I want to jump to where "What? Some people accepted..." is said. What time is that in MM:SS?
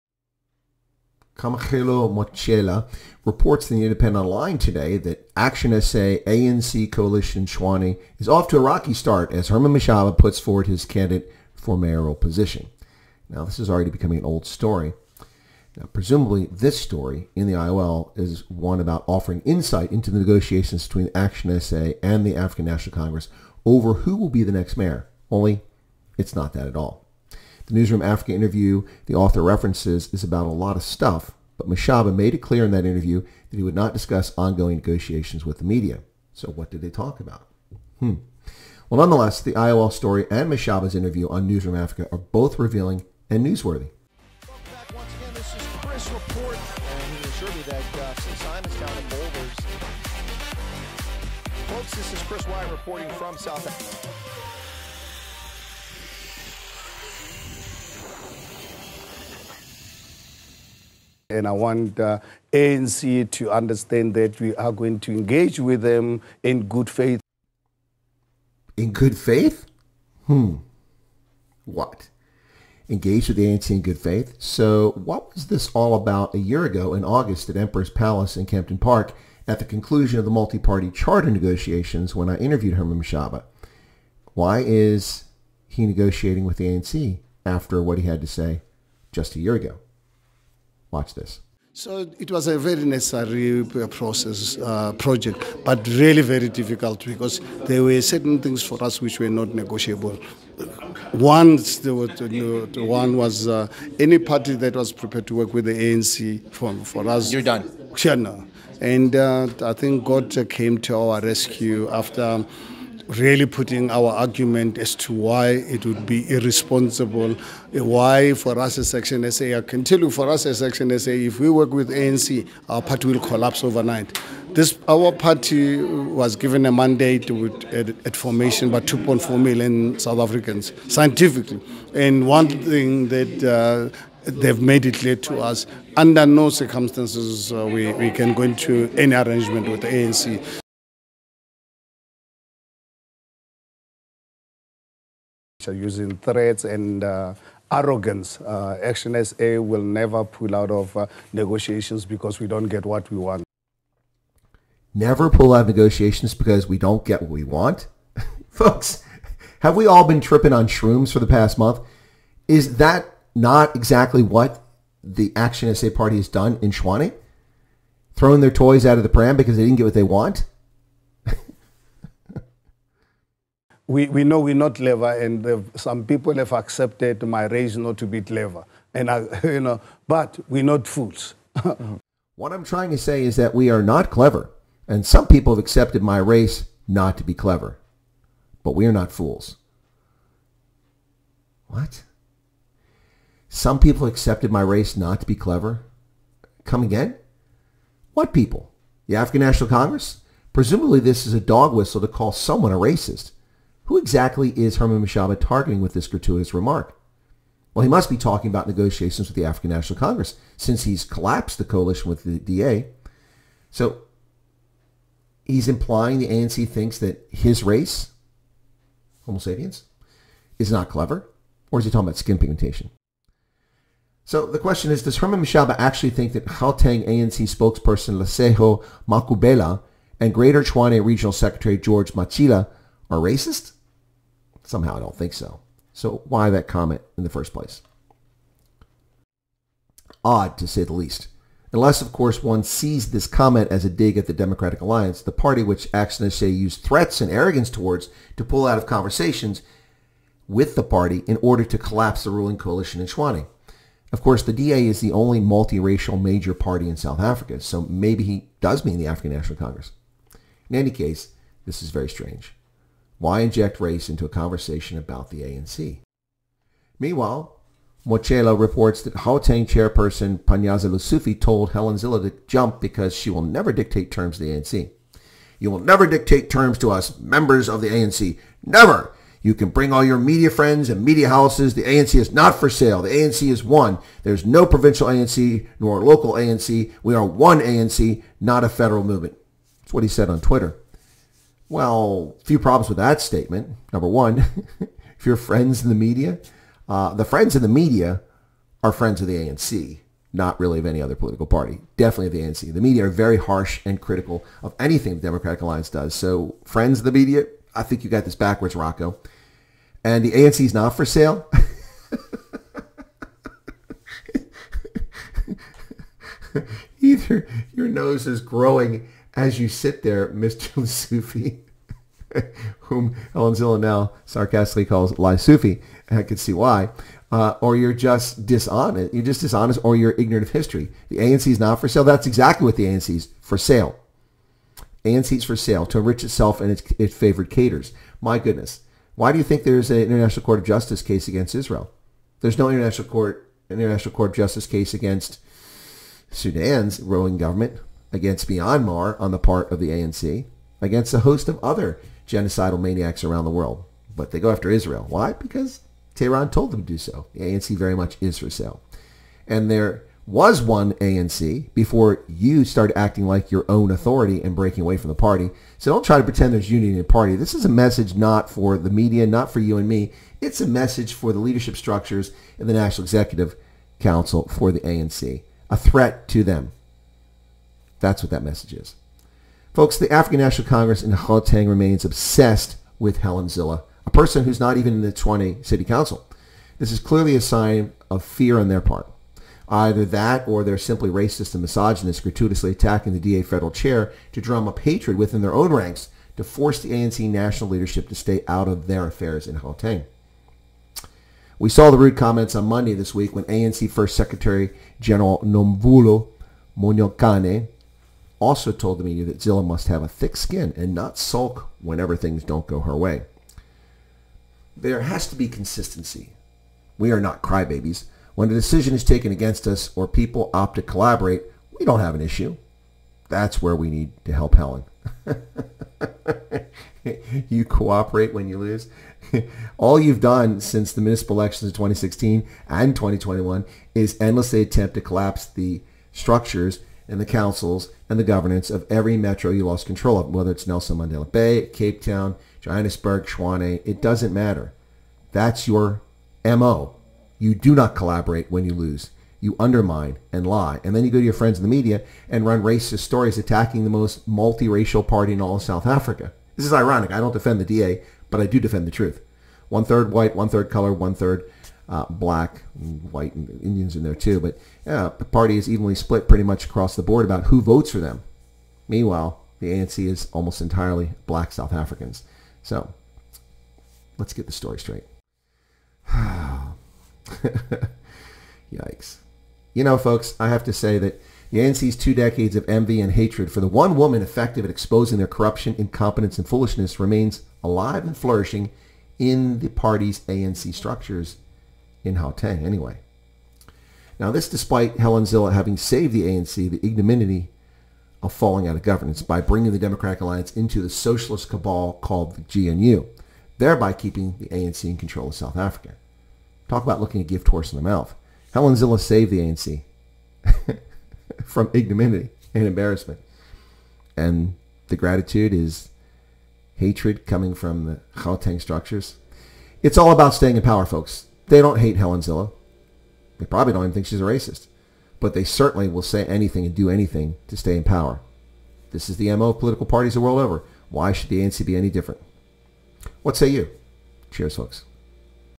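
03:11.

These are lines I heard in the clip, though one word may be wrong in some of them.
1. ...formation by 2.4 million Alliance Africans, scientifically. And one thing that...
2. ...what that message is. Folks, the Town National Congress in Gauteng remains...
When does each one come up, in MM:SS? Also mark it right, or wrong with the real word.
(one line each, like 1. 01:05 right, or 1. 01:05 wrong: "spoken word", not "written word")
1. 02:08 wrong: "South", not "Alliance"
2. 06:18 wrong: "African", not "Town".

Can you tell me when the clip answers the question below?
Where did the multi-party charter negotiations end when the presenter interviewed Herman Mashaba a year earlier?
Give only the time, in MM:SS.
01:17.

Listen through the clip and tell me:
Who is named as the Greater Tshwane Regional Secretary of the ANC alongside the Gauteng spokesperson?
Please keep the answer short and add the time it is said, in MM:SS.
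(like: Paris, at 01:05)
George Matjila, at 03:51.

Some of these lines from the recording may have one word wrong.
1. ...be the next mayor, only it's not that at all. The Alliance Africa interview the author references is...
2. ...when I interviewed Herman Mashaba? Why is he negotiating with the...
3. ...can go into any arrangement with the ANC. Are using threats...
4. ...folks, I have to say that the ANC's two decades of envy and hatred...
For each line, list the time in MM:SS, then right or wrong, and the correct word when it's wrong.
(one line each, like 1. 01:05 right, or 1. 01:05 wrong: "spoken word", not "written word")
1. 00:24 wrong: "Newsroom", not "Alliance"
2. 01:22 right
3. 02:18 right
4. 07:59 right.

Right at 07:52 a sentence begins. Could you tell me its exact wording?
So let's get the story straight.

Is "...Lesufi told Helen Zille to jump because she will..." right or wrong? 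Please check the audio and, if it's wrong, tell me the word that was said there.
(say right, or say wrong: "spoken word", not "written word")
right.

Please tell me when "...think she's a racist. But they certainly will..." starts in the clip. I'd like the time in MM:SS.
08:43.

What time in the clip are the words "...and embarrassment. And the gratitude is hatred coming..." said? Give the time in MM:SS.
08:32.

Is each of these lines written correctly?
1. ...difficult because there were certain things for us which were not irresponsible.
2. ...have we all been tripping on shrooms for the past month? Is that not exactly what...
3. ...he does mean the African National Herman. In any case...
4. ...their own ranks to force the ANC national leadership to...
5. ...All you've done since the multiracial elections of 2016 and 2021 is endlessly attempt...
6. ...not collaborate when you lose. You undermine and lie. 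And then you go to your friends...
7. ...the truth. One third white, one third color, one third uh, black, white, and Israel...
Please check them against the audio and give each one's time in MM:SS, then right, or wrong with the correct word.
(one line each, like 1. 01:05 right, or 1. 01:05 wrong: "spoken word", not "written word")
1. 01:36 wrong: "negotiable", not "irresponsible"
2. 02:39 right
3. 04:18 wrong: "Congress", not "Herman"
4. 06:35 right
5. 07:09 wrong: "municipal", not "multiracial"
6. 07:27 right
7. 07:38 wrong: "Indians", not "Israel".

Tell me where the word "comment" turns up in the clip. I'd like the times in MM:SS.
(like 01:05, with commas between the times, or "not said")
03:56, 04:03, 06:42.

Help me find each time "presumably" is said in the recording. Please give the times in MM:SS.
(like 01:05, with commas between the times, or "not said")
00:15, 03:20.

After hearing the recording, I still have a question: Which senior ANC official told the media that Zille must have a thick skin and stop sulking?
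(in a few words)
Nomvula Mokonyane.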